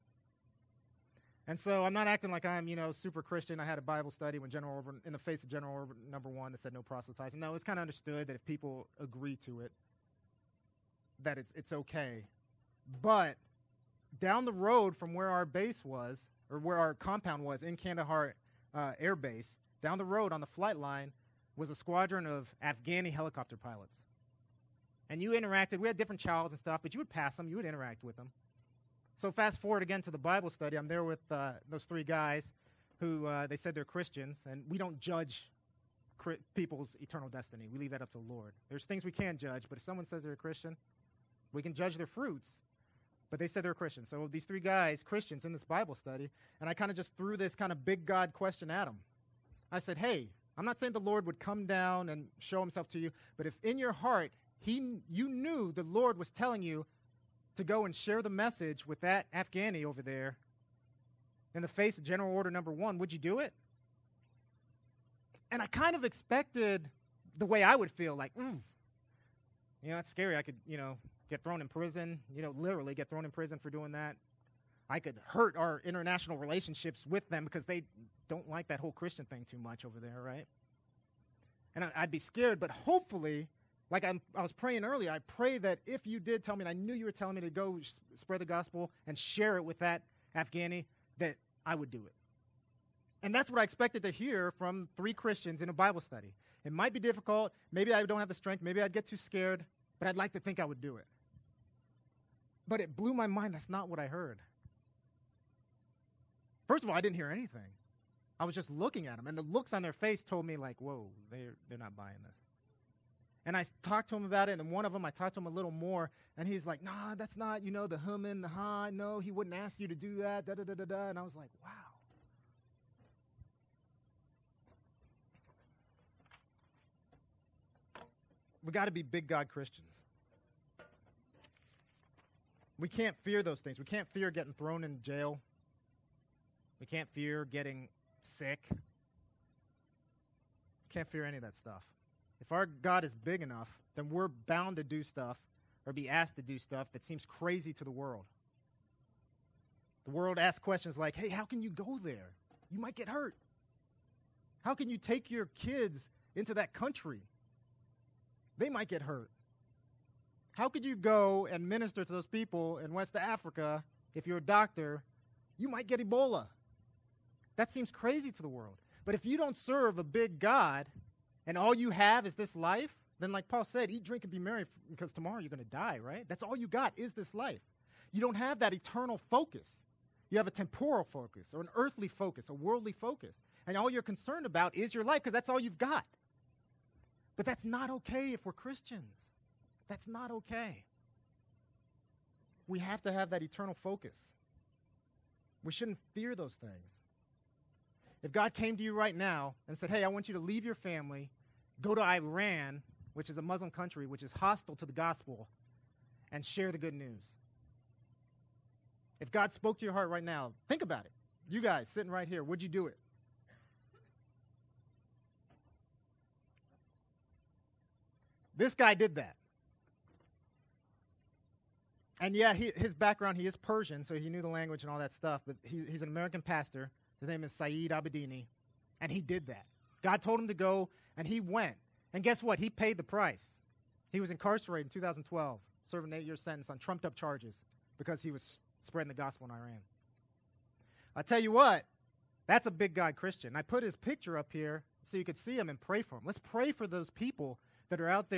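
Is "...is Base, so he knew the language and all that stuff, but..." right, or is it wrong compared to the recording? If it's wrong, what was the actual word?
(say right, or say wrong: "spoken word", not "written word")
wrong: "Persian", not "Base".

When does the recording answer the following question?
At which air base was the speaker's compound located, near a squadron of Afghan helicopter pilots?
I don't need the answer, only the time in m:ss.
0:17.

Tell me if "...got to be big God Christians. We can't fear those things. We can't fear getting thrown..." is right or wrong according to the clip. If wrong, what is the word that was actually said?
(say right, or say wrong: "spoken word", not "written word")
right.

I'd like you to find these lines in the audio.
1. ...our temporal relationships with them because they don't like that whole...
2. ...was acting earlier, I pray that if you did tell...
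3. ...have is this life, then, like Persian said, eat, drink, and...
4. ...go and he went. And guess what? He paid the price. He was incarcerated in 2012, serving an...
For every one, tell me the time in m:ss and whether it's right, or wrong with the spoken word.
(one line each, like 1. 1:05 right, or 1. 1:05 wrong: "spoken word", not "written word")
1. 1:15 wrong: "international", not "temporal"
2. 1:24 wrong: "praying", not "acting"
3. 2:51 wrong: "Paul", not "Persian"
4. 3:50 right.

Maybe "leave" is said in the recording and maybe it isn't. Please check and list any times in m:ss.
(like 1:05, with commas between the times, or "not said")
0:37, 3:20.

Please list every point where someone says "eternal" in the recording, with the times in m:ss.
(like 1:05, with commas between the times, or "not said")
0:36, 2:58, 3:13.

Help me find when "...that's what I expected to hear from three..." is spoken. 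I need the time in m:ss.
1:33.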